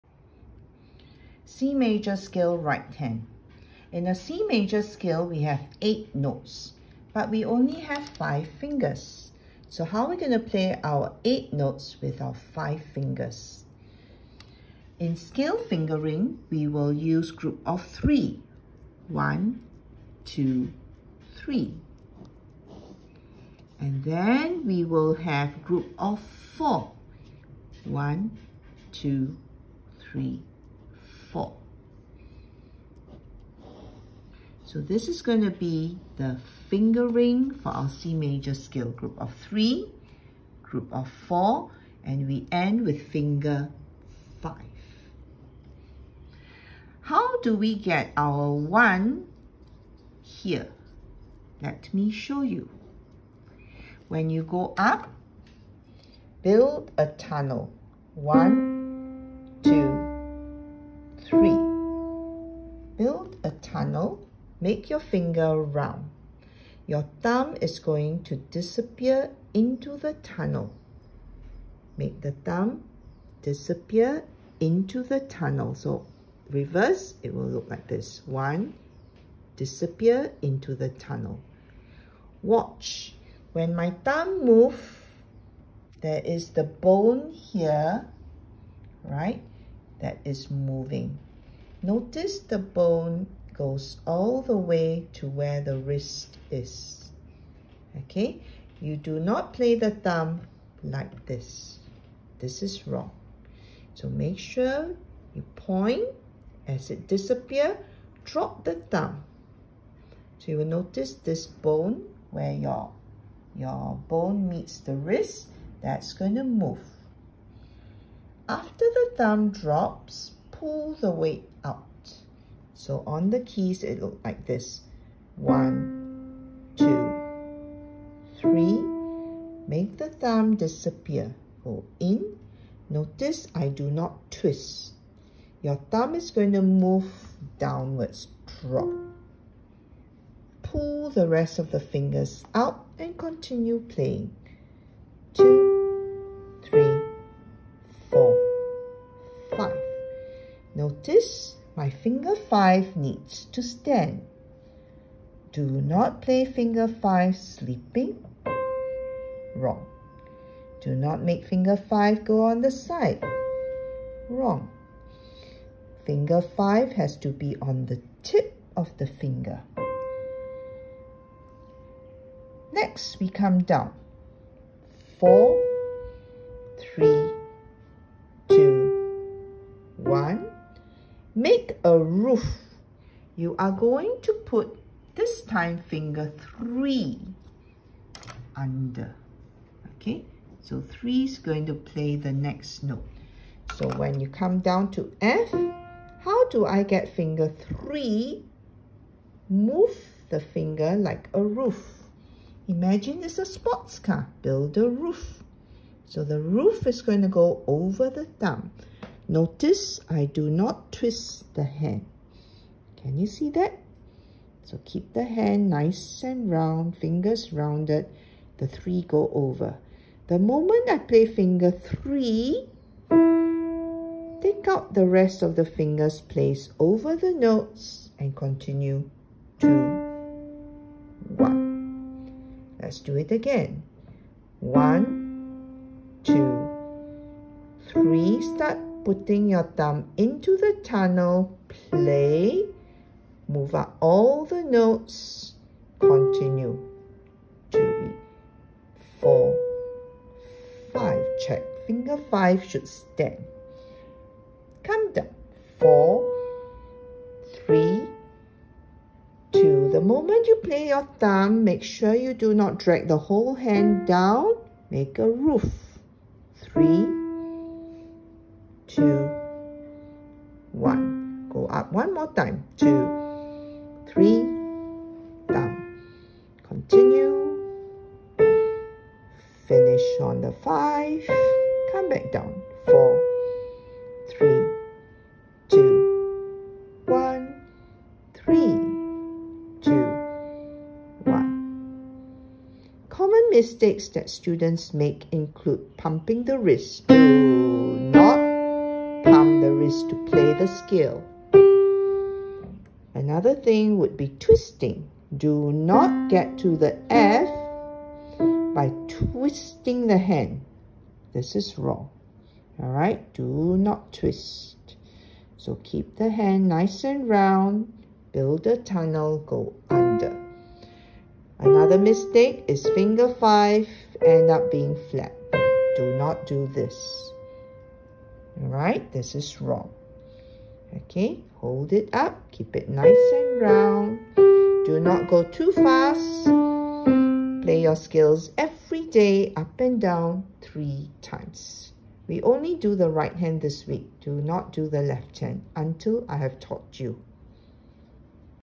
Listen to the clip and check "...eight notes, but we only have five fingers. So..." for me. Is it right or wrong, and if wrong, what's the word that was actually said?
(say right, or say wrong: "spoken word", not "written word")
right.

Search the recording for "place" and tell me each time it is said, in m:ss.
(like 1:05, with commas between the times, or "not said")
3:46.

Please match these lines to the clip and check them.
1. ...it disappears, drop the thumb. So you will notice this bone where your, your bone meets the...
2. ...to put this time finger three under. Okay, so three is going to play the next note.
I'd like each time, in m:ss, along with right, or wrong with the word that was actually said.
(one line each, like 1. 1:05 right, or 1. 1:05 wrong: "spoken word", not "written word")
1. 1:46 right
2. 3:04 right.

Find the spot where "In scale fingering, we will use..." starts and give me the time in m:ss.
0:14.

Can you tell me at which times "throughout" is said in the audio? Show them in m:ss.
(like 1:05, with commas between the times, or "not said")
not said.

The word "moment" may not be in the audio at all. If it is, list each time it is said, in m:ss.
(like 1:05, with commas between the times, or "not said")
3:40, 4:20.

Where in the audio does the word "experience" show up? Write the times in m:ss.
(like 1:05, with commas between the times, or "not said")
not said.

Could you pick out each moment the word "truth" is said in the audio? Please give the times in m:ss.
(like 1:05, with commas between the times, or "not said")
not said.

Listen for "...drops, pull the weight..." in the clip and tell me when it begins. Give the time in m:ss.
1:59.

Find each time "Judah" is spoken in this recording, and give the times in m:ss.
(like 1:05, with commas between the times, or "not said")
not said.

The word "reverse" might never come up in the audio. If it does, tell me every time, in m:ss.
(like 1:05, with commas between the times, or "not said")
1:16.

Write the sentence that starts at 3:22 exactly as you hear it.
Imagine it's a sports car, build a roof.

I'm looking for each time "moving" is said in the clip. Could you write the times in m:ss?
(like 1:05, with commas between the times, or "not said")
1:30.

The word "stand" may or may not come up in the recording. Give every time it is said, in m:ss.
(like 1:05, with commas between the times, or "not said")
2:33, 4:12.